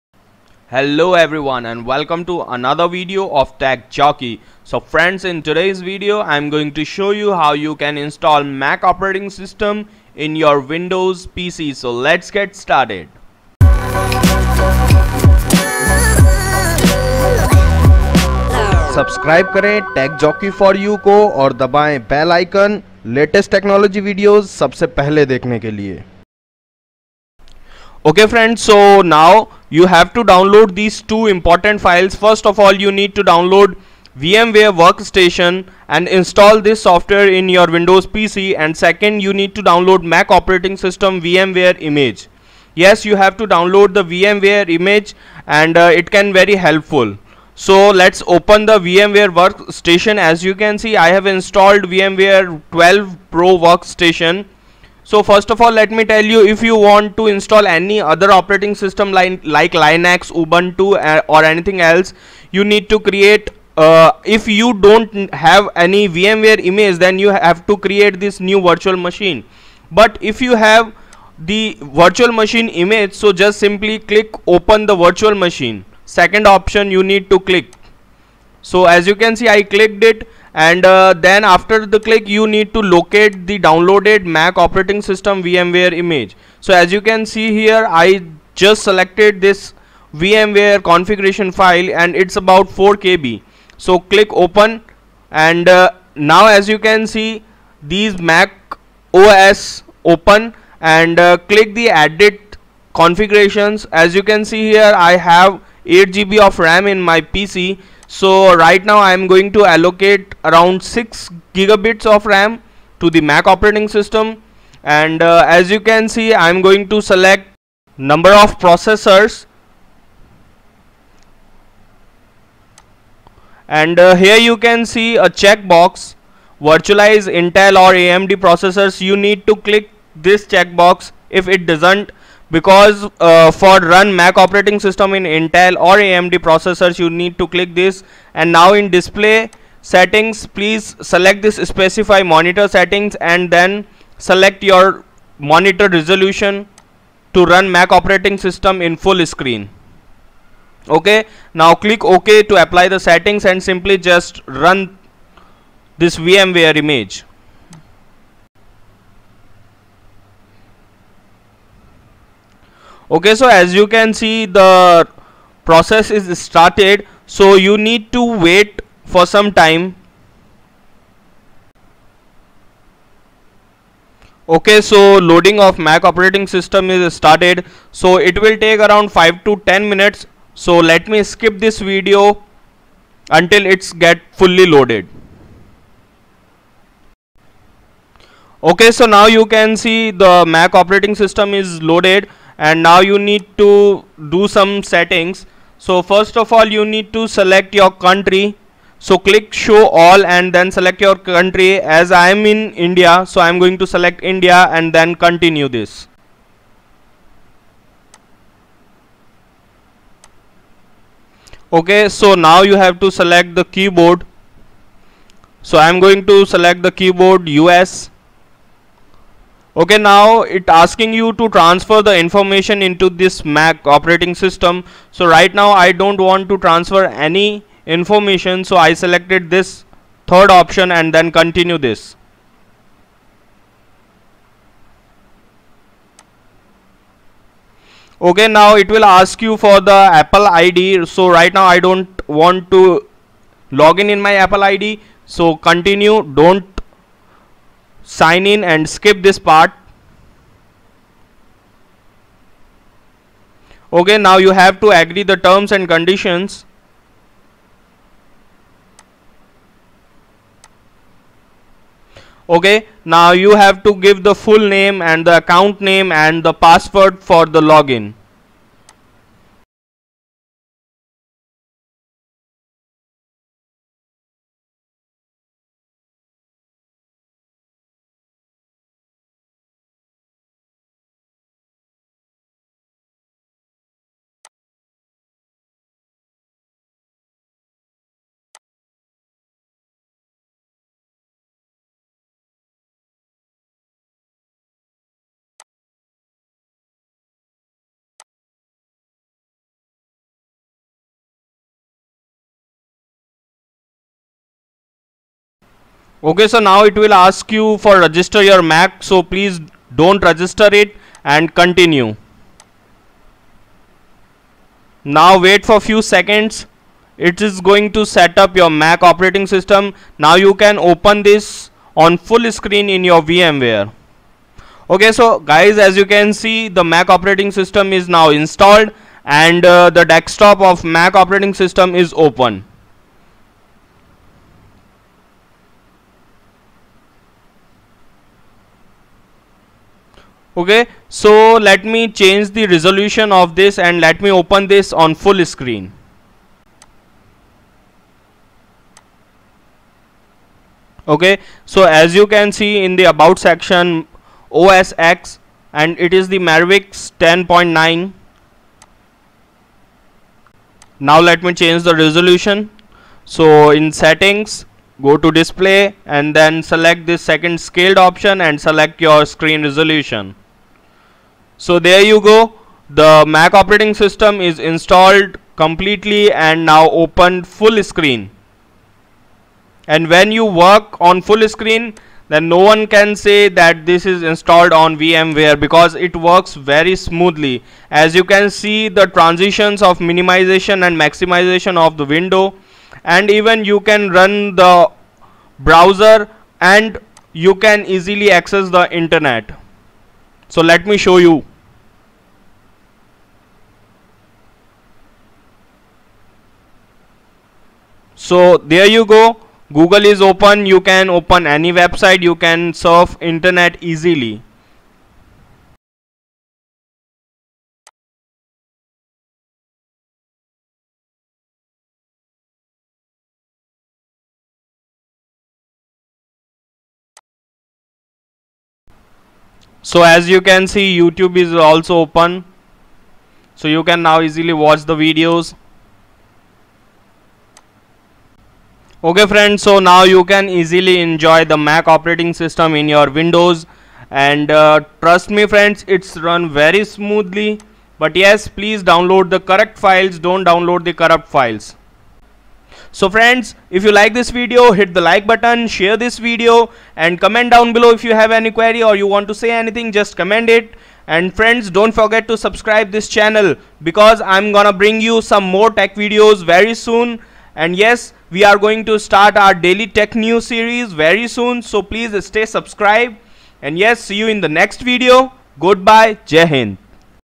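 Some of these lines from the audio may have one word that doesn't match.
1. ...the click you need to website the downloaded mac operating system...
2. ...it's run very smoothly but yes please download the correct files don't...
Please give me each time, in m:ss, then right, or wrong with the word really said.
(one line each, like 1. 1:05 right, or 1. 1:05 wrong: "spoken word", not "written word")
1. 1:21 wrong: "locate", not "website"
2. 7:25 right.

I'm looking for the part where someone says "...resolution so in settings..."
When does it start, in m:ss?
6:01.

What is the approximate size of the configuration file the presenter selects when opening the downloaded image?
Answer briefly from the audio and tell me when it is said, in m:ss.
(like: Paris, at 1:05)
4 KB, at 1:32.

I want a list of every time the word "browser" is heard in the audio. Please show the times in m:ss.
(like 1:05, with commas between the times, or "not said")
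6:35.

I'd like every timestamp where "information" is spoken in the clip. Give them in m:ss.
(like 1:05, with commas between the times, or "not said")
3:42, 3:47.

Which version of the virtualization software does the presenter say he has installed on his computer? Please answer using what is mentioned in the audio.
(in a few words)
VMware 12 Pro.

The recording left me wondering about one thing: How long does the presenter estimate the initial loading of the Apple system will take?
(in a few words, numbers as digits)
5 to 10 minutes.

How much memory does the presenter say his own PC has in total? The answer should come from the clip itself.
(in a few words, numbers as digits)
8 GB.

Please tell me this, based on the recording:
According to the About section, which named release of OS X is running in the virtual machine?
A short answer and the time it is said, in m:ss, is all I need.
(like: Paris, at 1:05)
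Mavericks 10.9, at 5:56.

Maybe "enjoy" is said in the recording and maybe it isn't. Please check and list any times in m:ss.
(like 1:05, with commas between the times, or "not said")
7:21.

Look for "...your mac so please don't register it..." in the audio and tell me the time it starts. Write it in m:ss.
5:08.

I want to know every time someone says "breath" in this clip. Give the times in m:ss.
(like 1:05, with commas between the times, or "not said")
not said.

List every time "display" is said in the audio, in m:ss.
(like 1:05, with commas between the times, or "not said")
2:18, 6:05.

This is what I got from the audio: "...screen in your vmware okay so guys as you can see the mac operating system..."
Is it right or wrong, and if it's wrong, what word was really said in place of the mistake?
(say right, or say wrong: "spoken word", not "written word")
right.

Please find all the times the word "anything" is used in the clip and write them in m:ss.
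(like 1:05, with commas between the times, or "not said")
1:01, 7:39.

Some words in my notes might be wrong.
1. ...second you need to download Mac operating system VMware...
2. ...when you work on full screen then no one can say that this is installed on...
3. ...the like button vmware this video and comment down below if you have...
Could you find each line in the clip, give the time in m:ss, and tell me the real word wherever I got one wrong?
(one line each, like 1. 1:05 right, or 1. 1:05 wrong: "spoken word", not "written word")
1. 0:38 right
2. 6:20 right
3. 7:34 wrong: "share", not "vmware".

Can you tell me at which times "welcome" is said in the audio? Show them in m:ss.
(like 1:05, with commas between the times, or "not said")
0:01.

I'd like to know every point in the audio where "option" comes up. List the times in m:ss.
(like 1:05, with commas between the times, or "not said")
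1:16, 3:50, 6:07.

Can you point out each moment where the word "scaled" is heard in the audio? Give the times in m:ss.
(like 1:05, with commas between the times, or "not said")
6:07.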